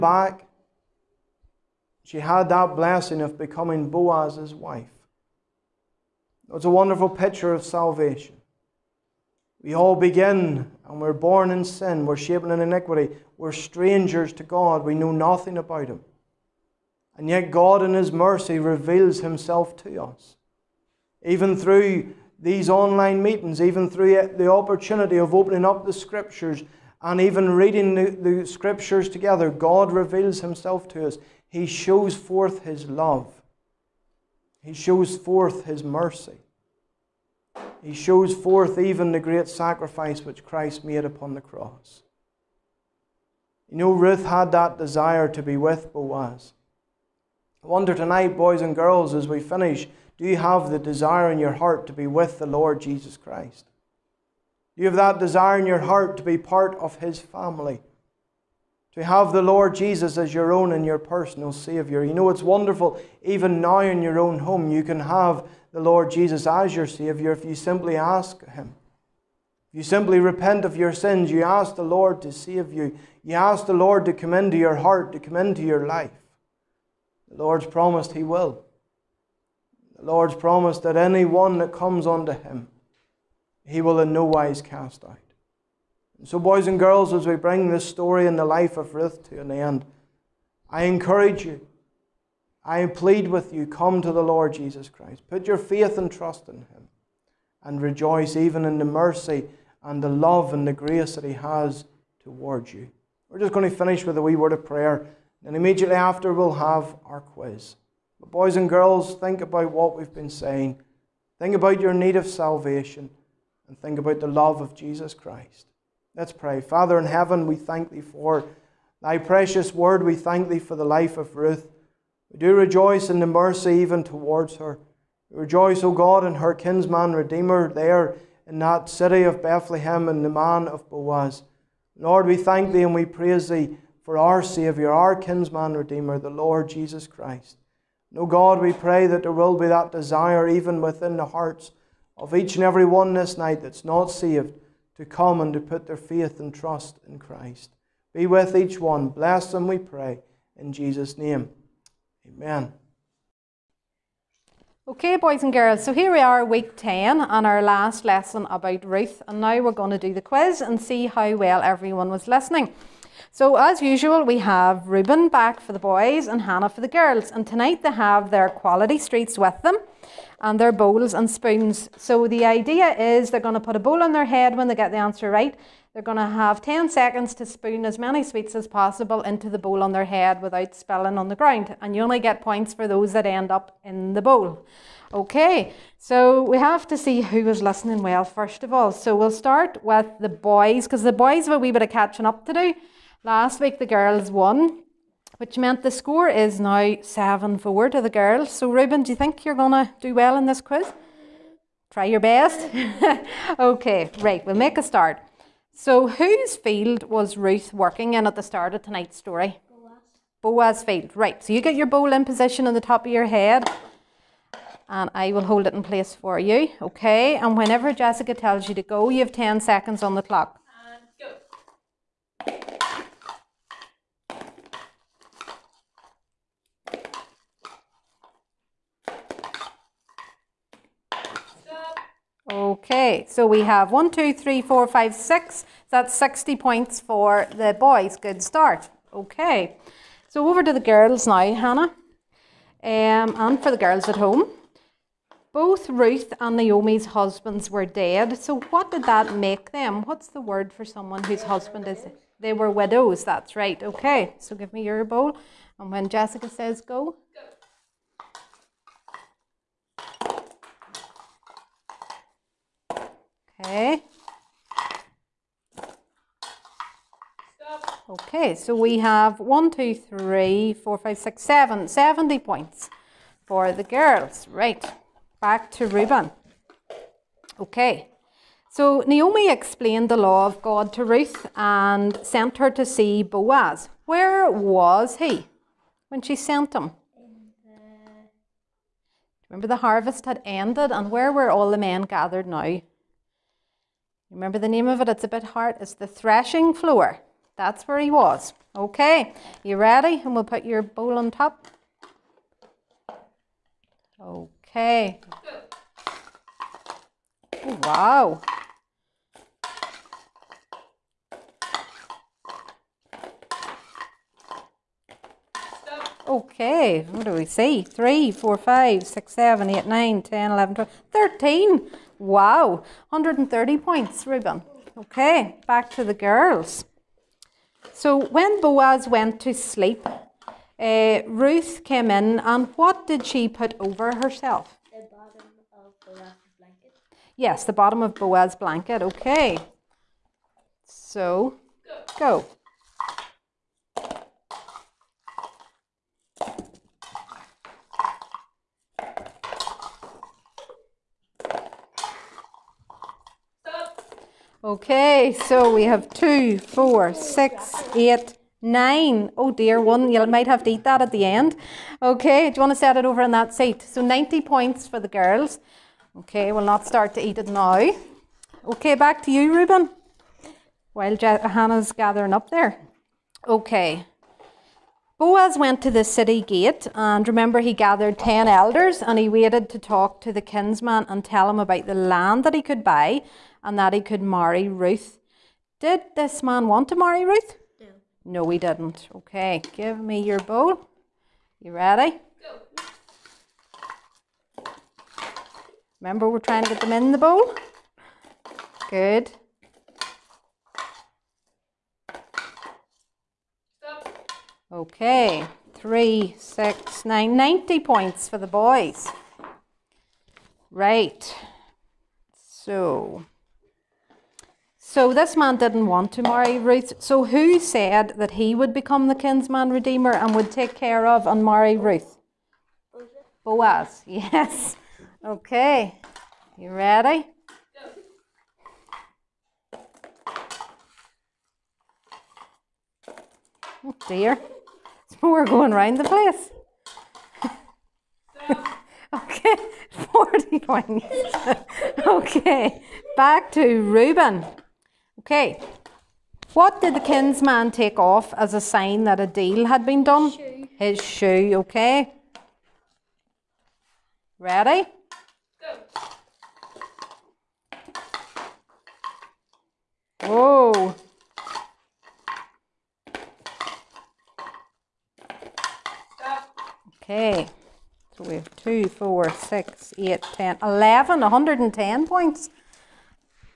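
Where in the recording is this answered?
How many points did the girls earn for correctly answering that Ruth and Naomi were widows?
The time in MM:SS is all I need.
04:31.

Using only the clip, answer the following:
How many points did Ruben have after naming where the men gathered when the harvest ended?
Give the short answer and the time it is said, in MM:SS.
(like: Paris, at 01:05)
130, at 05:23.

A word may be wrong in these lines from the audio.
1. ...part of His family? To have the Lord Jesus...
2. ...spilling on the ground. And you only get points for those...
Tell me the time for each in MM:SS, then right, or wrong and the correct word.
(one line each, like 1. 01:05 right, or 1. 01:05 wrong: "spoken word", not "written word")
1. 00:56 right
2. 03:00 right.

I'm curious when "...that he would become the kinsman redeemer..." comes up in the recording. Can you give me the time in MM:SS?
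06:58.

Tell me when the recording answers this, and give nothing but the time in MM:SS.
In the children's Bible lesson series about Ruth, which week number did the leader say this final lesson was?
02:36.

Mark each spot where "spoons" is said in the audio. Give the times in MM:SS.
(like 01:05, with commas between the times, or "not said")
02:51, 02:57.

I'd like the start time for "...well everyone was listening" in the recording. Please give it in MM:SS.
02:41.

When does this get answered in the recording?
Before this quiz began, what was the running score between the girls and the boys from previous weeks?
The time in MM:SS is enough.
03:17.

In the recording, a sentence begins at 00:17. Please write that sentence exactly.
And yet, God, in His mercy, reveals Himself to us.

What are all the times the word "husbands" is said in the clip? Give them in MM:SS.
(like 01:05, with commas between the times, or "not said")
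04:07, 04:11.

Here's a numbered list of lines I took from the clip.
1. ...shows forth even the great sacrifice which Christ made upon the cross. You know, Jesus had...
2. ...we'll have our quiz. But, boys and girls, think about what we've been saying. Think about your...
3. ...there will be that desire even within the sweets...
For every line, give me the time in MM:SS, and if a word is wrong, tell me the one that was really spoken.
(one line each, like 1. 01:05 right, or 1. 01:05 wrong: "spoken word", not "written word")
1. 00:37 wrong: "Ruth", not "Jesus"
2. 01:46 right
3. 02:19 wrong: "hearts", not "sweets".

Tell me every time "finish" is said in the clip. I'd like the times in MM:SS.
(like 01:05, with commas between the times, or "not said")
00:49, 01:43.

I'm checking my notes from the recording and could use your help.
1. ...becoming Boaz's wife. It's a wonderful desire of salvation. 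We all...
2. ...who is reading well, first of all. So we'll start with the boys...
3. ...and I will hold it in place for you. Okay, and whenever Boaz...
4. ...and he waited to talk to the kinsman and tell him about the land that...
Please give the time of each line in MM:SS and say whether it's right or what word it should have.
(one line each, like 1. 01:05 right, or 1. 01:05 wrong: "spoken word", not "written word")
1. 00:03 wrong: "picture", not "desire"
2. 03:07 wrong: "listening", not "reading"
3. 03:34 wrong: "Jessica", not "Boaz"
4. 06:19 right.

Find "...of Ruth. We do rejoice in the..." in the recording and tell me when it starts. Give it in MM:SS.
02:01.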